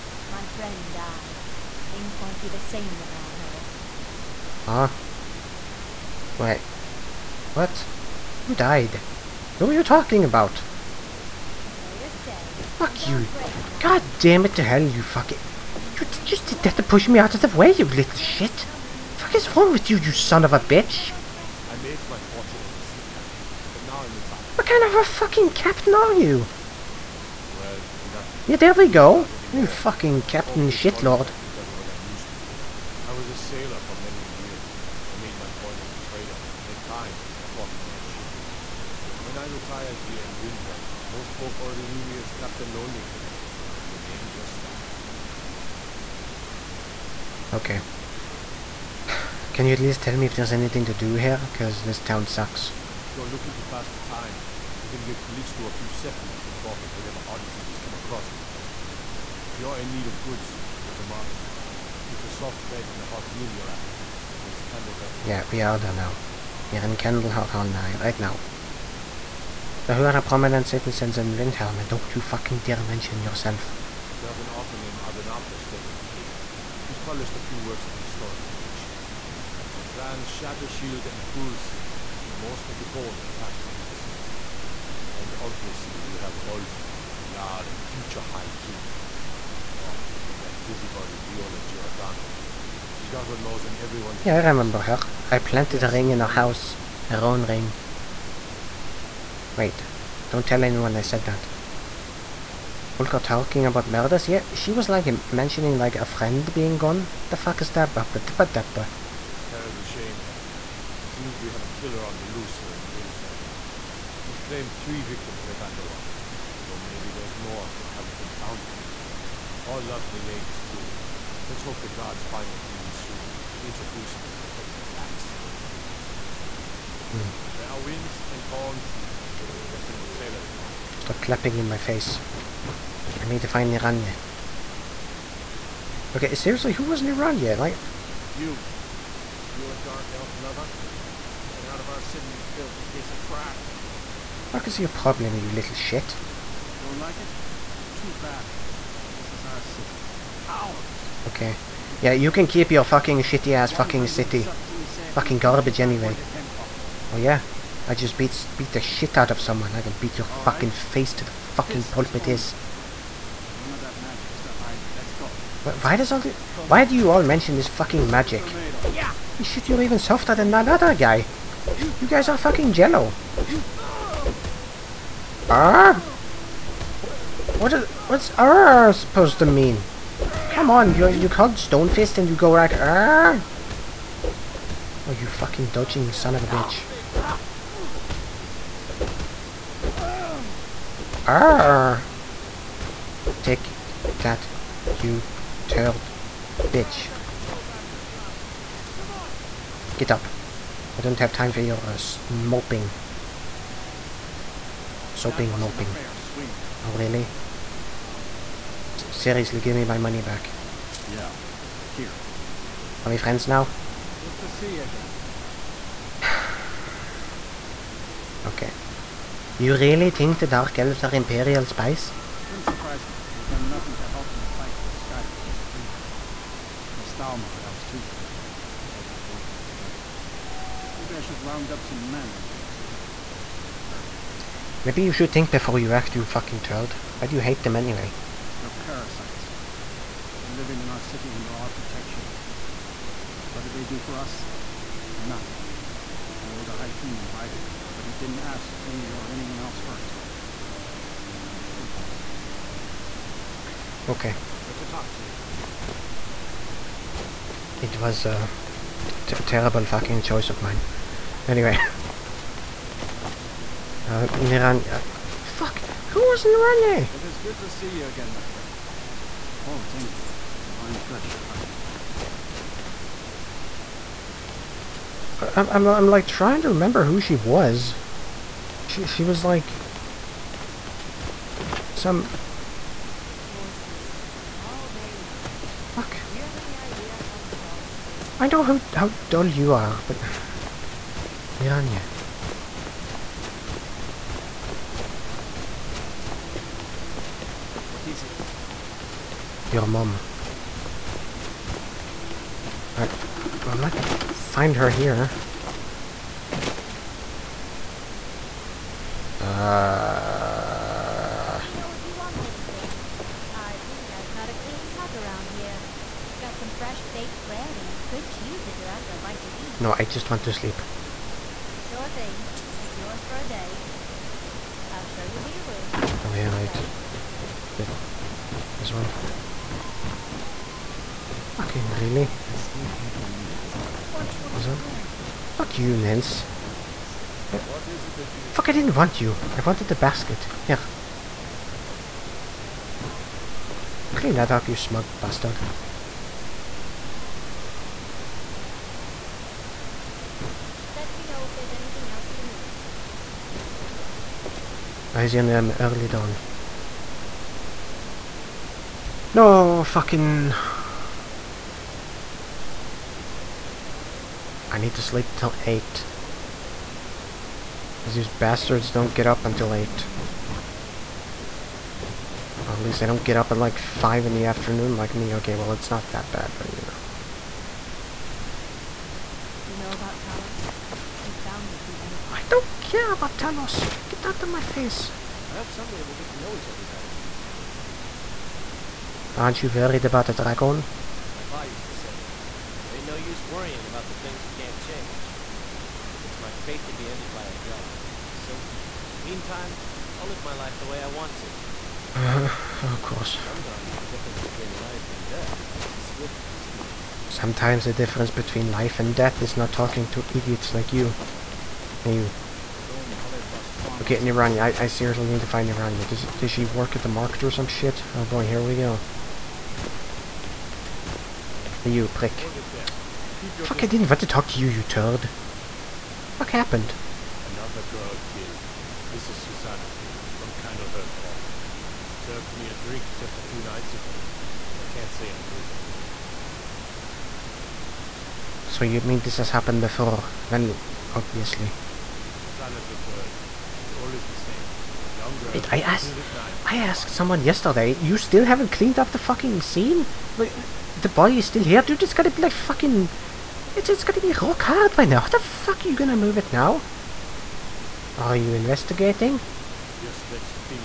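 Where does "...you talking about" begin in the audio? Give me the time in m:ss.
0:09.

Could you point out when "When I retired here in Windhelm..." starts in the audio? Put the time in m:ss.
0:39.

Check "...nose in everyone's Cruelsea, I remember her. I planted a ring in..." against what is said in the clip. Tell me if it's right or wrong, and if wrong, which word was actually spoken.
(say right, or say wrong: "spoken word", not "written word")
wrong: "Yeah", not "Cruelsea".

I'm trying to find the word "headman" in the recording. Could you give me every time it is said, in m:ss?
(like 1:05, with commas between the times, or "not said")
2:04.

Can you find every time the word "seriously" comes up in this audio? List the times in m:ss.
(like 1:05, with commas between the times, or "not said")
2:16, 3:29, 6:54.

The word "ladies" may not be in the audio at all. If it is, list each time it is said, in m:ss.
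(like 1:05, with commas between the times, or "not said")
2:00.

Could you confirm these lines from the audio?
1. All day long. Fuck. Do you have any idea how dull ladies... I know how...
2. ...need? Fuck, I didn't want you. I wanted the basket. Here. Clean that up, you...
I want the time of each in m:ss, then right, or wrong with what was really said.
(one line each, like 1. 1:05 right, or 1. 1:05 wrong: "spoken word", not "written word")
1. 4:44 wrong: "horses", not "ladies"
2. 5:38 right.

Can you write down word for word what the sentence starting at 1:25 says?
And obviously you have Ulfric, the Jarl and future High King.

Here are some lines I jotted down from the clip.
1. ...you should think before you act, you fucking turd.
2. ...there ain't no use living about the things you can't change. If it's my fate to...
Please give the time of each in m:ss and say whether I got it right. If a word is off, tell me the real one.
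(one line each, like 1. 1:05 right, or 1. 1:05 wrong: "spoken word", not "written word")
1. 3:55 right
2. 6:32 wrong: "worrying", not "living".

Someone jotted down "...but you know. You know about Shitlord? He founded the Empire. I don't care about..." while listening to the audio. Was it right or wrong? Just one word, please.
wrong.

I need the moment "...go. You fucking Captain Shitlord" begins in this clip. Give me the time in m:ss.
0:28.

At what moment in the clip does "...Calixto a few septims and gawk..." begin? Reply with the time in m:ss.
0:55.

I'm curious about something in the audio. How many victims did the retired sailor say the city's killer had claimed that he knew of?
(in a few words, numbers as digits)
3.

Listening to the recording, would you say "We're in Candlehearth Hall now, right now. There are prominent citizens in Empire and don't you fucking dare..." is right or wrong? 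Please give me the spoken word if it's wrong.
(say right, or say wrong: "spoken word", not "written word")
wrong: "Windhelm", not "Empire".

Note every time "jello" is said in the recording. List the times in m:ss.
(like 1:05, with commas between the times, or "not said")
2:52.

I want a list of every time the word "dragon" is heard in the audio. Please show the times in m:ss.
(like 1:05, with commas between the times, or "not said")
6:30, 6:37.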